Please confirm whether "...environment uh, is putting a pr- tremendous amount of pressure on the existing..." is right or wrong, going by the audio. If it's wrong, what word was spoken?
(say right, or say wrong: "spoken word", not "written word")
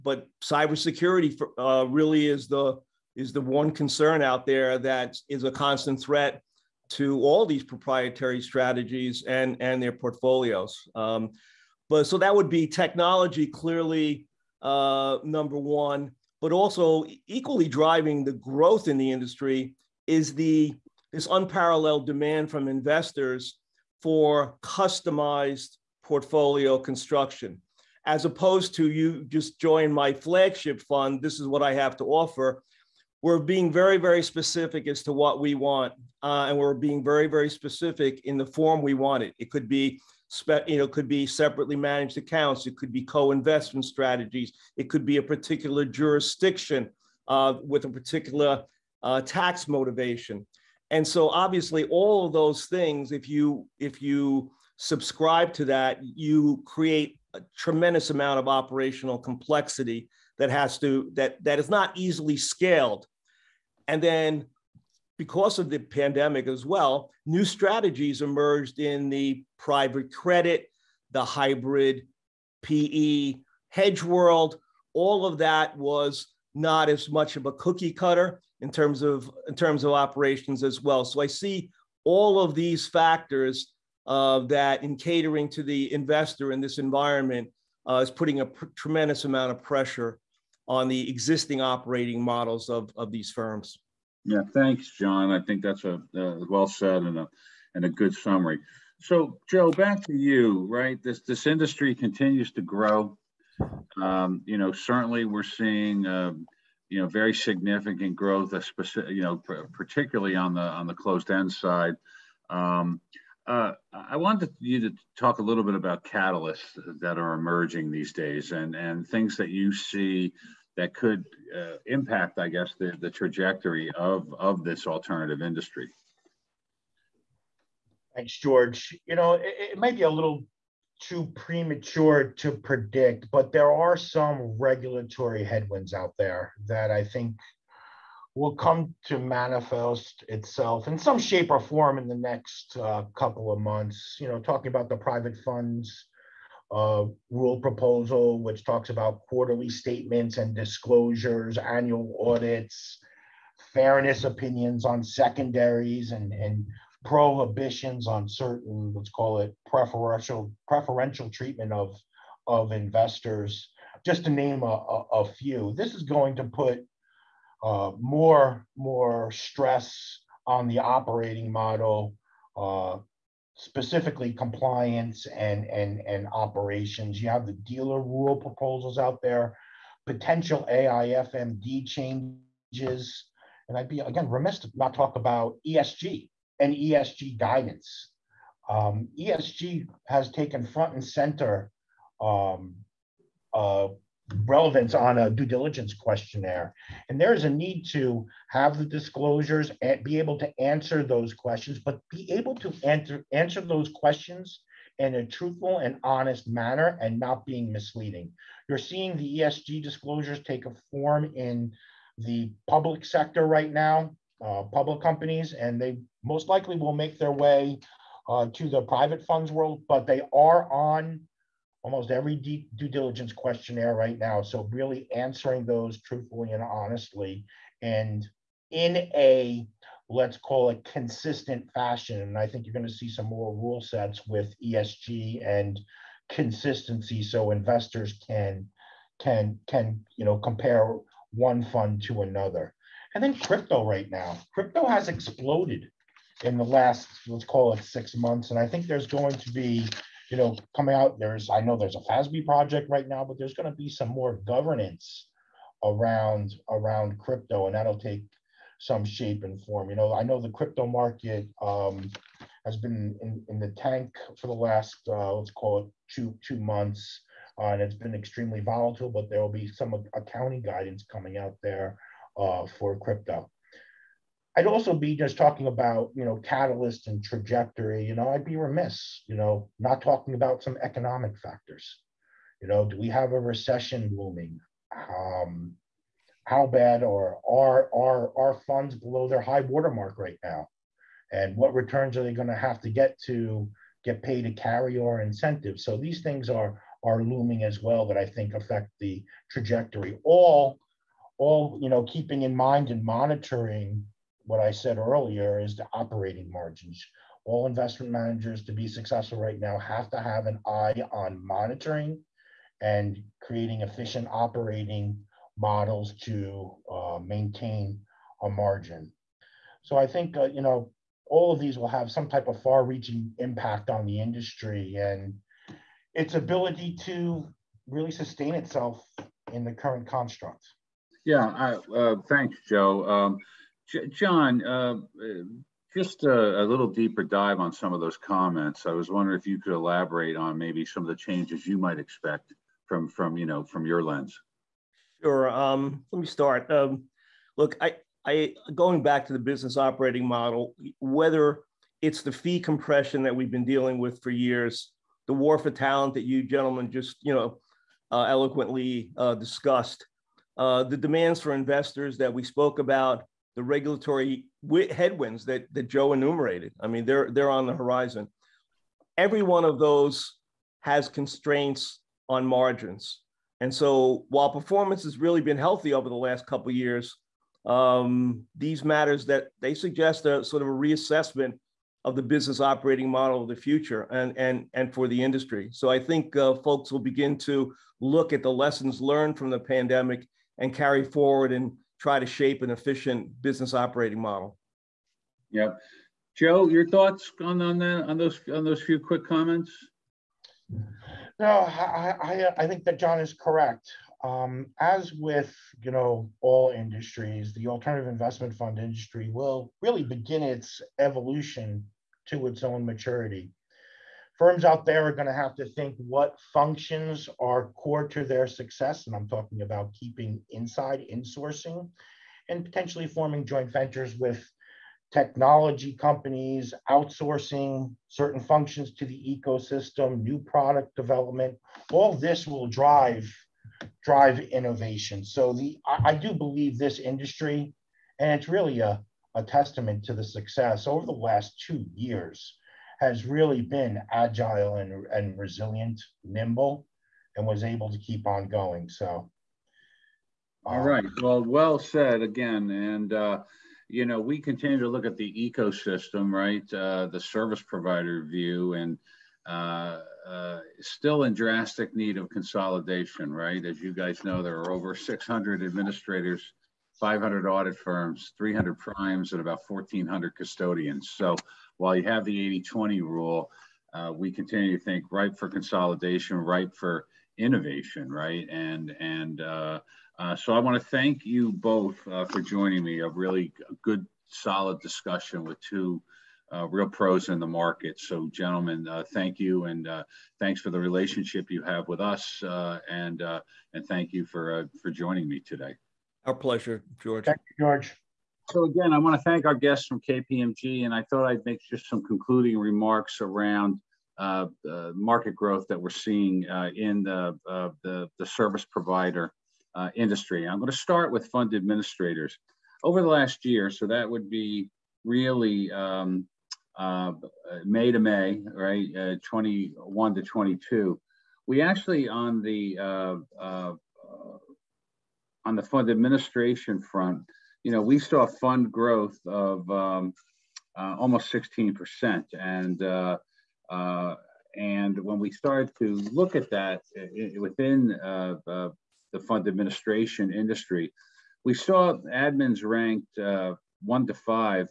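right.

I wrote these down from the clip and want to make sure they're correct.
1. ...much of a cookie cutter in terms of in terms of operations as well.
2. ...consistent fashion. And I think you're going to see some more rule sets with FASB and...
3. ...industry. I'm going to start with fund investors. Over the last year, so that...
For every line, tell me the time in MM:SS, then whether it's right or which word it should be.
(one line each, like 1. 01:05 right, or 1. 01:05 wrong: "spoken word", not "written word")
1. 01:17 right
2. 03:50 wrong: "ESG", not "FASB"
3. 08:29 wrong: "administrators", not "investors".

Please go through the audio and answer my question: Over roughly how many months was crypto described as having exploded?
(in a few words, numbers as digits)
6 months.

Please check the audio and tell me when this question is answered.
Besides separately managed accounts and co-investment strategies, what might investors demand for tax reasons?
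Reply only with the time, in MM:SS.
00:45.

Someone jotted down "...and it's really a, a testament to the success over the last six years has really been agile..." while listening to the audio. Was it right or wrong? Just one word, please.
wrong.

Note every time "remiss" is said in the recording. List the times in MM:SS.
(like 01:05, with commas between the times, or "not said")
03:04, 04:38.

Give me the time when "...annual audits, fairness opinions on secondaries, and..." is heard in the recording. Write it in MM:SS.
02:31.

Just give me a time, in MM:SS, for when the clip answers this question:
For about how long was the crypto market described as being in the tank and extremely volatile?
04:26.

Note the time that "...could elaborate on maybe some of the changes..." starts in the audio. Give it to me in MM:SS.
05:39.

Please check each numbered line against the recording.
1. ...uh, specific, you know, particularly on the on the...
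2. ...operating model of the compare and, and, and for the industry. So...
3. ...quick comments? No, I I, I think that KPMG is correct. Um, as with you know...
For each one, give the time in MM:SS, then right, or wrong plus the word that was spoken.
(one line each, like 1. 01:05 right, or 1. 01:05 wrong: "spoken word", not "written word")
1. 01:48 right
2. 06:22 wrong: "future", not "compare"
3. 06:38 wrong: "John", not "KPMG".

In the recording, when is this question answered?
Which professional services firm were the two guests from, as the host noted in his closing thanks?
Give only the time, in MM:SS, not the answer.
08:20.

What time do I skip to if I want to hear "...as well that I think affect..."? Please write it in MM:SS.
04:57.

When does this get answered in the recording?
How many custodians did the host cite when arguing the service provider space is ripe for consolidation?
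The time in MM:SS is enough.
07:49.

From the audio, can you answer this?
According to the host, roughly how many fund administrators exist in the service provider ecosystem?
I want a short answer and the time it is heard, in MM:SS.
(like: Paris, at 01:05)
600, at 07:44.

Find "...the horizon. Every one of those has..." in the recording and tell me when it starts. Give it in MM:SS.
06:07.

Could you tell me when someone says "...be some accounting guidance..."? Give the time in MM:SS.
04:29.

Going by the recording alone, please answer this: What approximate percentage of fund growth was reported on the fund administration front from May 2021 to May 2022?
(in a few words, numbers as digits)
Almost 16%.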